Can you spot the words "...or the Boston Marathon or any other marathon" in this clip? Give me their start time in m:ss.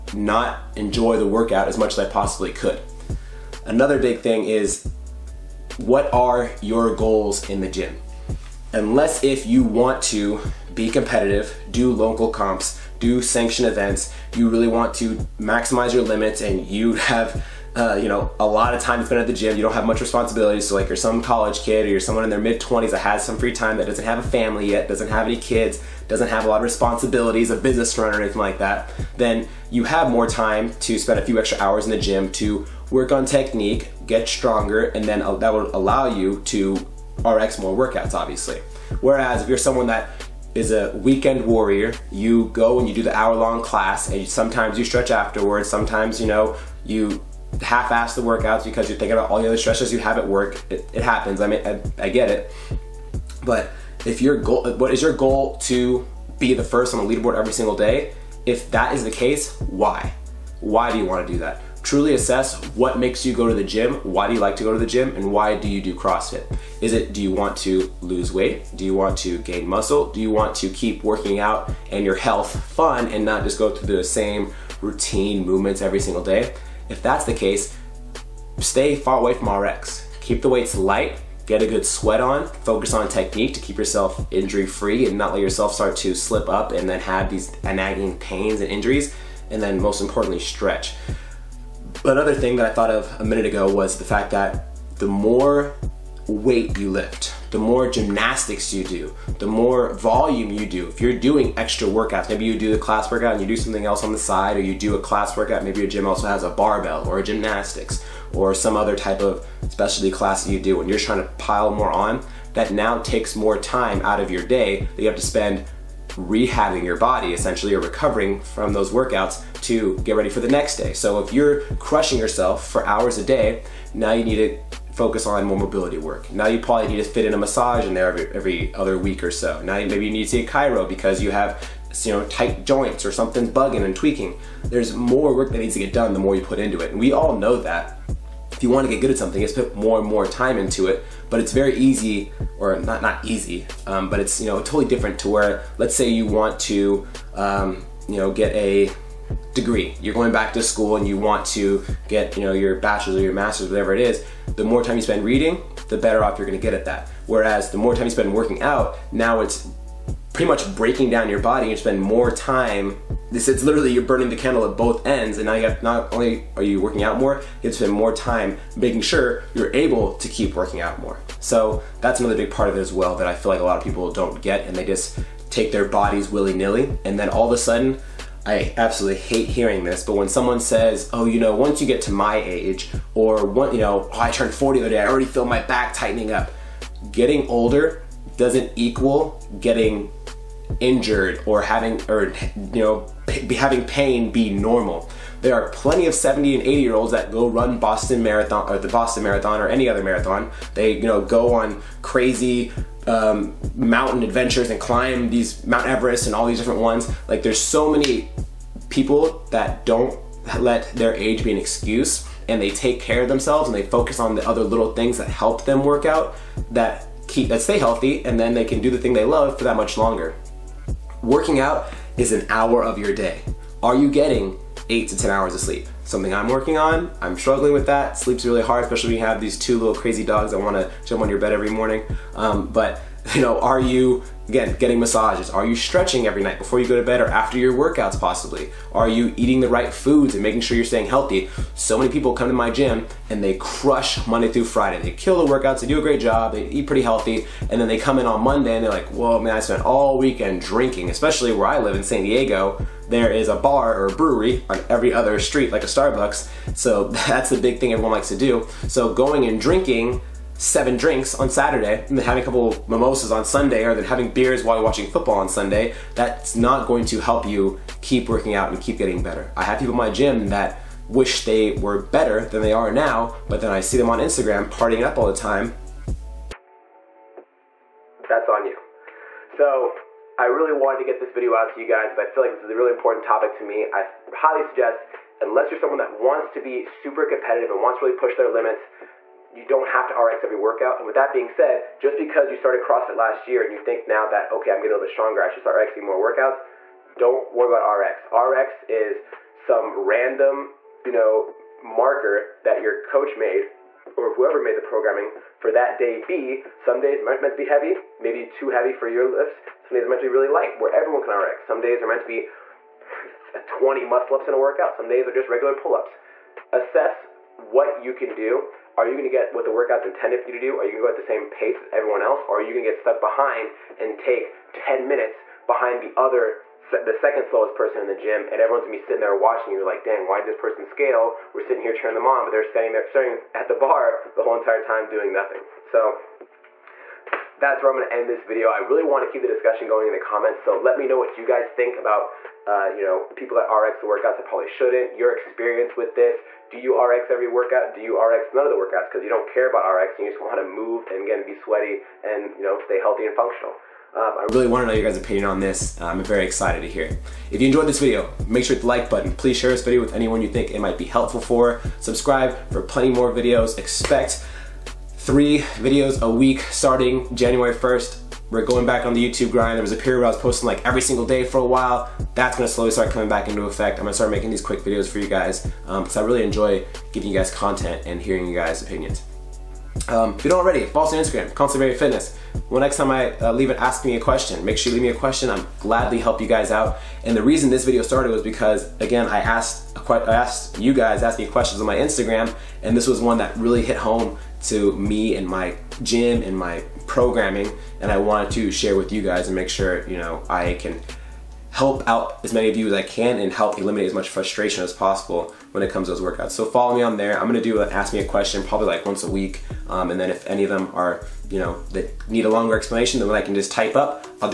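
3:18.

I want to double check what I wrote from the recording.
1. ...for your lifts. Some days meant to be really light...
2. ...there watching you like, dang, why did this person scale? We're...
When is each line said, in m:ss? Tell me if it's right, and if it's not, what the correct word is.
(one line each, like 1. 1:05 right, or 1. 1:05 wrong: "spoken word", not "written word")
1. 5:08 right
2. 5:29 right.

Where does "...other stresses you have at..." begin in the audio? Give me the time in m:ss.
0:49.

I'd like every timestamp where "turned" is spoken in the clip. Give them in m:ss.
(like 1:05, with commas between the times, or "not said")
3:04.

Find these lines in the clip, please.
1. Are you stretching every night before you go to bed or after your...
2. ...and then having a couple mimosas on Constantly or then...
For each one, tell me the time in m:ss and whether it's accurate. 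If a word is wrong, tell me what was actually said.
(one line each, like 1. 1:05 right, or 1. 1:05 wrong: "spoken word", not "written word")
1. 3:55 right
2. 4:22 wrong: "Sunday", not "Constantly".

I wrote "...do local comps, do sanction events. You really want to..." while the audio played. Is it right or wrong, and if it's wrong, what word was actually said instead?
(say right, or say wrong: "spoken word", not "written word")
right.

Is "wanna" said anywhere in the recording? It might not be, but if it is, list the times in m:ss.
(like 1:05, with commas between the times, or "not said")
5:39, 5:50.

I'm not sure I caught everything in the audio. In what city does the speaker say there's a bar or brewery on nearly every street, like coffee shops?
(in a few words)
San Diego.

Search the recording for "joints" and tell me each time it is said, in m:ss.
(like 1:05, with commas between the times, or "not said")
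2:12.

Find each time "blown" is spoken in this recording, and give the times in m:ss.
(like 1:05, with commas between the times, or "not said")
not said.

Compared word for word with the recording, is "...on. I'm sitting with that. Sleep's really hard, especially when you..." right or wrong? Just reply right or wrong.
wrong.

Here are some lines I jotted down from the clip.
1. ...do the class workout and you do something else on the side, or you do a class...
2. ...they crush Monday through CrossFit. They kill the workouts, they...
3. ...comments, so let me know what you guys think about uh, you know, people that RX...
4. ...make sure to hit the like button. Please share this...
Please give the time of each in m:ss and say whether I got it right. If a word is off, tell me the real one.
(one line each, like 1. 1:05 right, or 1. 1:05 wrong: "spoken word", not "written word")
1. 1:42 right
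2. 4:03 wrong: "Friday", not "CrossFit"
3. 5:40 right
4. 5:58 right.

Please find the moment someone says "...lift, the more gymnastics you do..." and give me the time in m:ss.
1:36.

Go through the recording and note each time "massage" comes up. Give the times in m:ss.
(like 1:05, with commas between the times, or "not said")
2:07, 3:55.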